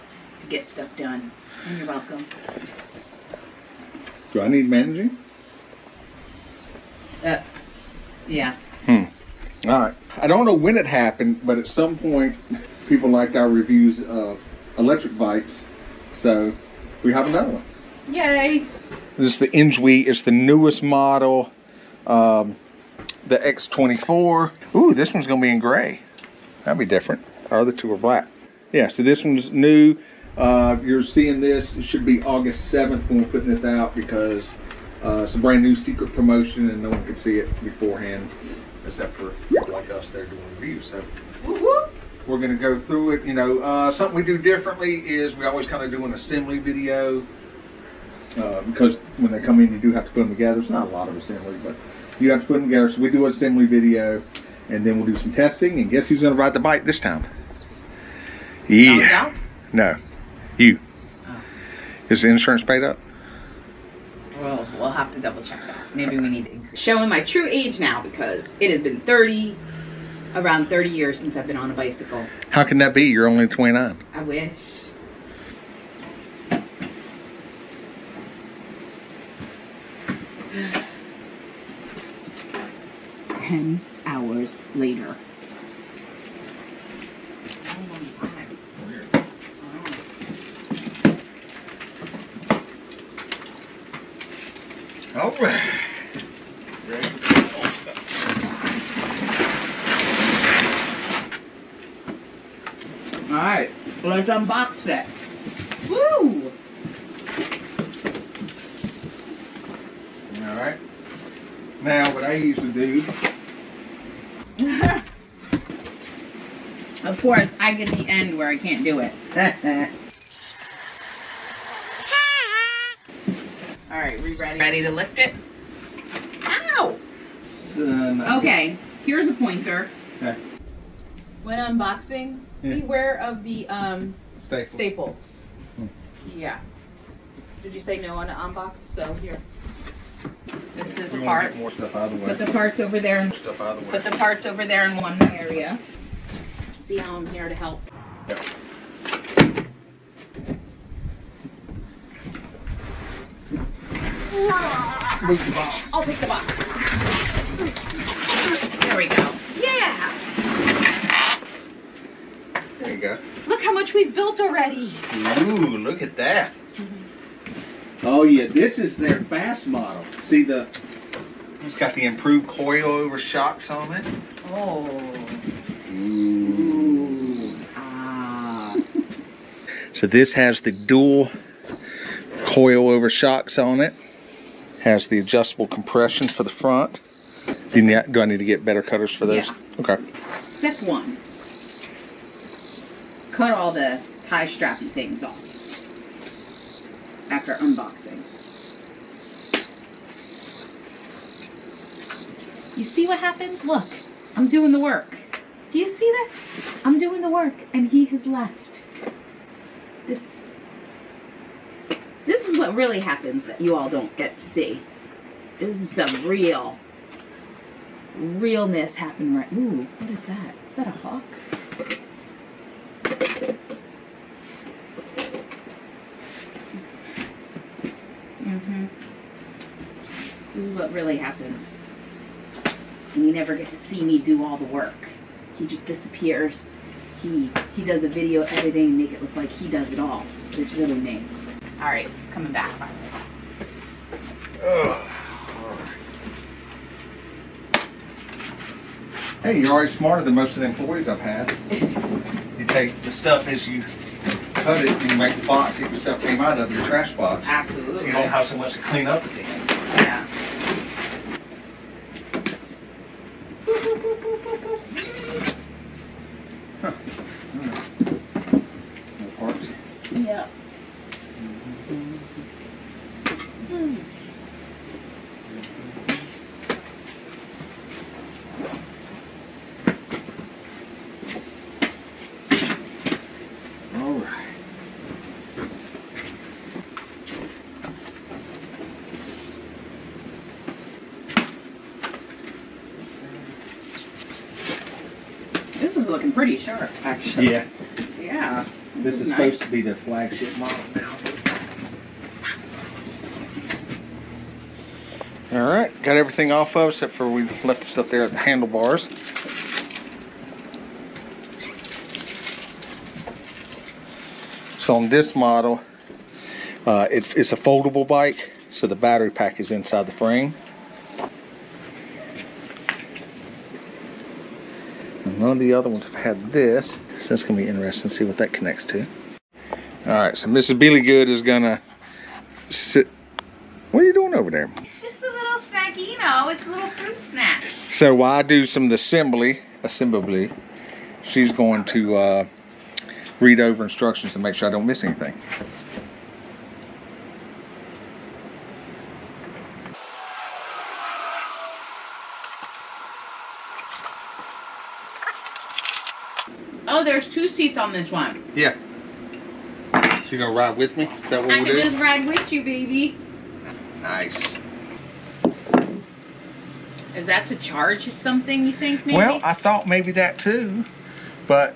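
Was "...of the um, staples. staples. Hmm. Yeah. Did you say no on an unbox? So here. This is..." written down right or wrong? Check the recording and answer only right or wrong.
right.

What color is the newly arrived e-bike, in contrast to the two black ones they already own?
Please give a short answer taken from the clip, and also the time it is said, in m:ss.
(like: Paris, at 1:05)
Gray, at 0:25.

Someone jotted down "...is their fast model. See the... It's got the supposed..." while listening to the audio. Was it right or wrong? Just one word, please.
wrong.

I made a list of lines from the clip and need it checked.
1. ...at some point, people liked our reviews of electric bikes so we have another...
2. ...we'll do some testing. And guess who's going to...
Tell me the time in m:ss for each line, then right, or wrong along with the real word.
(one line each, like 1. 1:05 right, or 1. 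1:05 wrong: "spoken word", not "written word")
1. 0:11 right
2. 0:54 right.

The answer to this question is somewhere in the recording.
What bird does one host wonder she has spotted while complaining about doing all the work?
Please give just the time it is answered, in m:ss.
3:40.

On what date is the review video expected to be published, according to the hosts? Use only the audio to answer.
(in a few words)
August 7th.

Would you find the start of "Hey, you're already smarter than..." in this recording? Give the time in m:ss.
4:09.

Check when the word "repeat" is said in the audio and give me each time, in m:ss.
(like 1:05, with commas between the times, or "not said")
not said.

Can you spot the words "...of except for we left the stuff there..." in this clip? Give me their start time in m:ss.
5:06.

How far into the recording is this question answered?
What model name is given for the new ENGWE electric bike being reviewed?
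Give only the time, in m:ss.
0:23.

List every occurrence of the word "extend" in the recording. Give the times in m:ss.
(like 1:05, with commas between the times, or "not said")
not said.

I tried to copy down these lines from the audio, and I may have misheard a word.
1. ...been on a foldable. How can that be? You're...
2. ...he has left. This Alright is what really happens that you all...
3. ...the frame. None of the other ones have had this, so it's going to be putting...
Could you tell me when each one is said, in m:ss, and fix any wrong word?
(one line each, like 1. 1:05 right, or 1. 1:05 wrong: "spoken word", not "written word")
1. 1:11 wrong: "bicycle", not "foldable"
2. 3:27 wrong: "This", not "Alright"
3. 5:20 wrong: "interesting", not "putting".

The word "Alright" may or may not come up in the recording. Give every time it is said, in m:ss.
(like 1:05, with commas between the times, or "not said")
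1:50, 2:03.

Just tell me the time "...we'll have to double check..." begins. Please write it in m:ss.
1:04.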